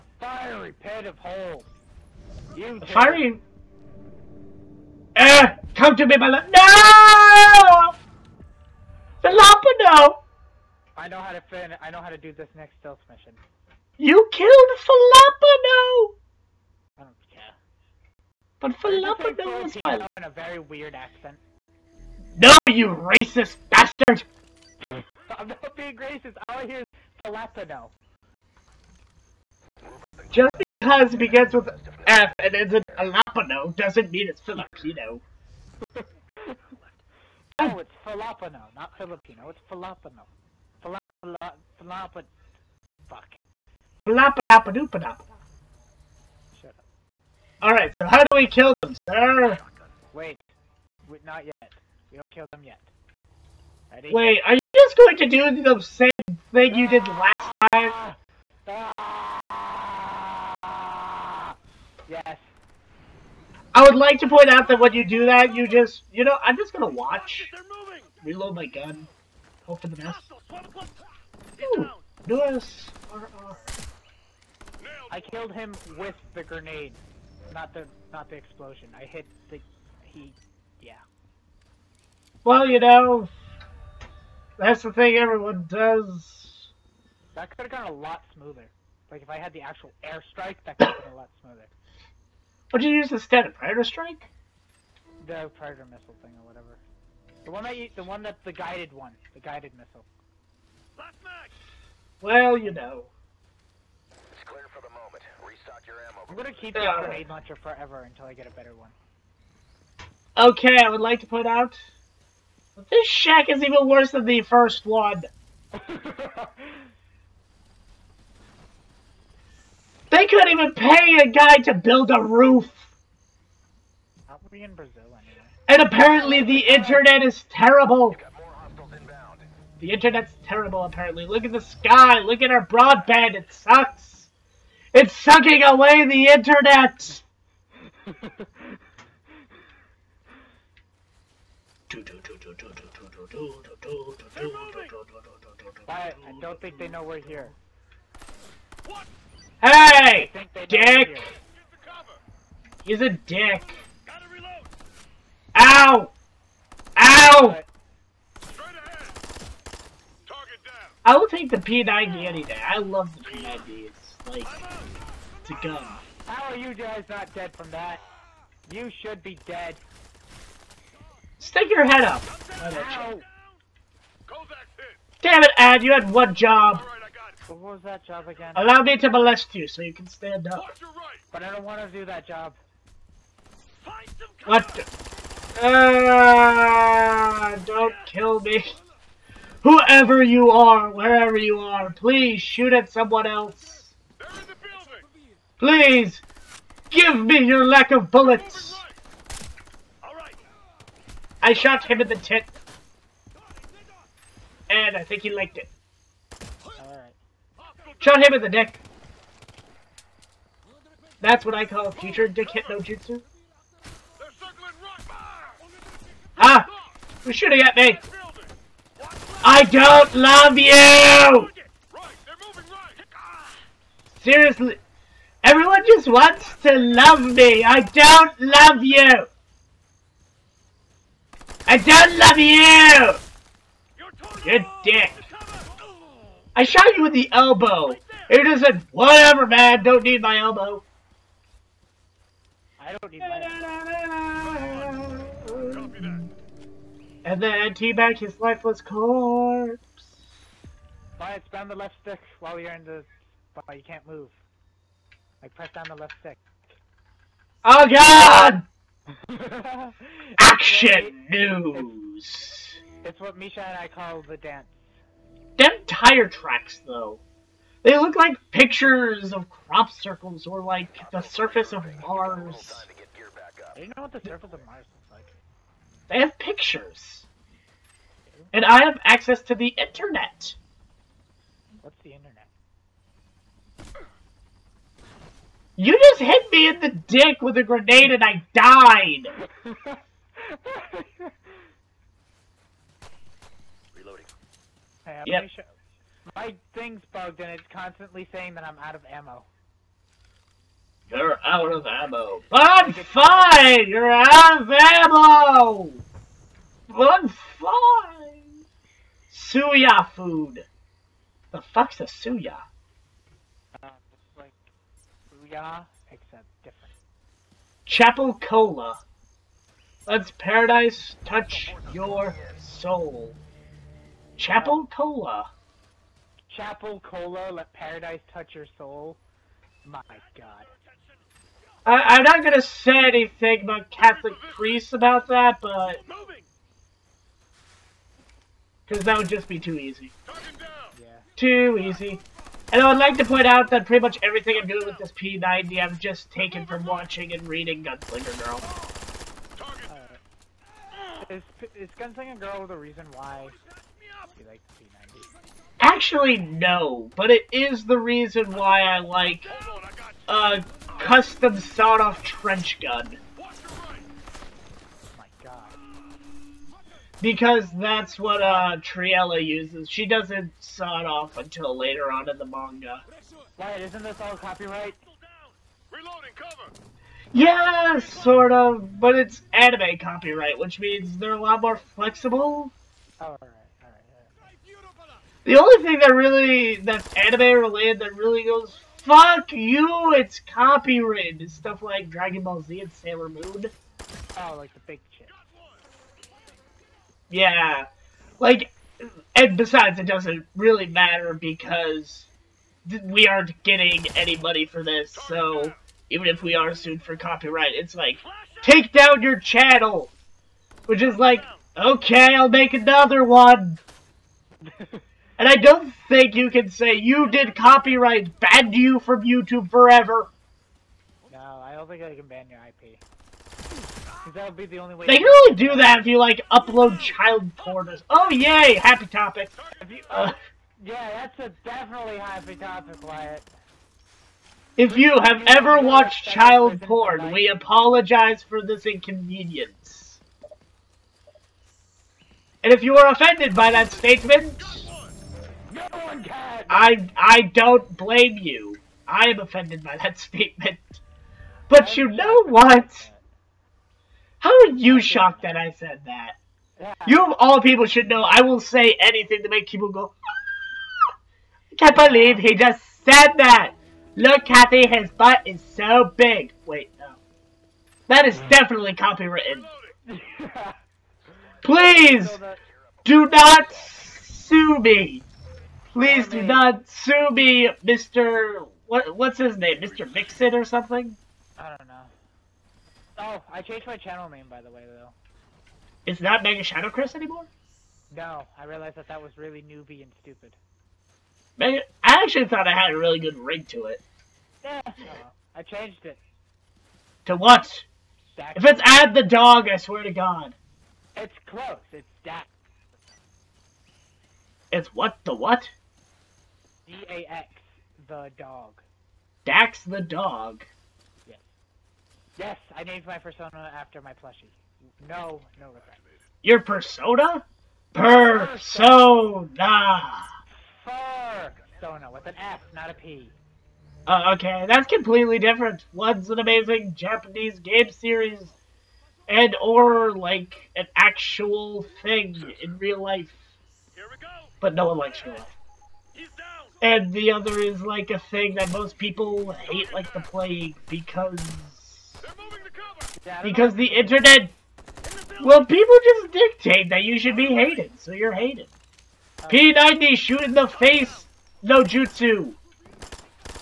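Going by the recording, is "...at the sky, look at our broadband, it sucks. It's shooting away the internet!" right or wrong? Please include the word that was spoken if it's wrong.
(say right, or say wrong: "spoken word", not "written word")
wrong: "sucking", not "shooting".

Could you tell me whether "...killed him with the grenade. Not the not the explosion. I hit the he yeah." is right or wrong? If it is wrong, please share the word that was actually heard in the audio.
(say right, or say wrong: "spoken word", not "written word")
right.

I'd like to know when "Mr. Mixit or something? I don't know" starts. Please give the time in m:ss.
7:59.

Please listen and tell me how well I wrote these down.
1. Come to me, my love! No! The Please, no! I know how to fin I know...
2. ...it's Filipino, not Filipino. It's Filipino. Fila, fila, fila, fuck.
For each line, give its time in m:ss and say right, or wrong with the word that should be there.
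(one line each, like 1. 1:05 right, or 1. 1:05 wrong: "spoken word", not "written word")
1. 0:05 wrong: "Lapa", not "Please"
2. 0:37 right.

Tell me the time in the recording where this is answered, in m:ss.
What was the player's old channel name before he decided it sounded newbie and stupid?
8:06.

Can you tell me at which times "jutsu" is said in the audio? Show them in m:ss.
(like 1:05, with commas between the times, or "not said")
3:32, 9:11.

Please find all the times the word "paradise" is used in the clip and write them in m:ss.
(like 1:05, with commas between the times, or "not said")
5:20, 5:27.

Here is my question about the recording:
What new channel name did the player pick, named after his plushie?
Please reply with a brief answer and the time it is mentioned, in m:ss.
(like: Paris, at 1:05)
Dax the dog, at 8:29.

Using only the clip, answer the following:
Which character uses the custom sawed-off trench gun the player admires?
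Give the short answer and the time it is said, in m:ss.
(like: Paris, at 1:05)
Triela, at 6:08.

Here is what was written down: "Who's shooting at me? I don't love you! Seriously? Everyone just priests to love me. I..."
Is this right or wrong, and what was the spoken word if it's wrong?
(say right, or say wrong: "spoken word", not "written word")
wrong: "wants", not "priests".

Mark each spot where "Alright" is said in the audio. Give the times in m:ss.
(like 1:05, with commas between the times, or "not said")
0:47.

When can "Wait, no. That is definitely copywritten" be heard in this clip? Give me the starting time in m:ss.
7:46.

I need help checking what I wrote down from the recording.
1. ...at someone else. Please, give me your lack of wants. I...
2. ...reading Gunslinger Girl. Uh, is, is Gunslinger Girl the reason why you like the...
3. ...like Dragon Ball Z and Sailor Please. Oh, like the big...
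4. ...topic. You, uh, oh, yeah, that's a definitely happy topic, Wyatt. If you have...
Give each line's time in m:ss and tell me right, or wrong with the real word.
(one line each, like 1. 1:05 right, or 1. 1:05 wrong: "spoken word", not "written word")
1. 3:12 wrong: "bullets", not "wants"
2. 5:47 right
3. 6:31 wrong: "Moon", not "Please"
4. 7:09 right.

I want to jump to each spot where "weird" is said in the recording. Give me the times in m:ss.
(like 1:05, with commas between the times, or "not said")
0:20.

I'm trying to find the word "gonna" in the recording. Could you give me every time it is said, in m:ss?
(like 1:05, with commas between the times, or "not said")
1:06, 1:46, 5:32.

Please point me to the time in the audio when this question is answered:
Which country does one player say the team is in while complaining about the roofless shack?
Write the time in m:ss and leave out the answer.
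2:04.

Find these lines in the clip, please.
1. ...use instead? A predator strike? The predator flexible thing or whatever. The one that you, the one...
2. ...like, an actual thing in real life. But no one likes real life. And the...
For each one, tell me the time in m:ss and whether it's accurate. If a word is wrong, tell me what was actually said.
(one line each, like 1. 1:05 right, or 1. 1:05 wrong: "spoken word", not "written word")
1. 1:32 wrong: "missile", not "flexible"
2. 8:50 right.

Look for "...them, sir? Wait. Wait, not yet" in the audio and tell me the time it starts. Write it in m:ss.
0:48.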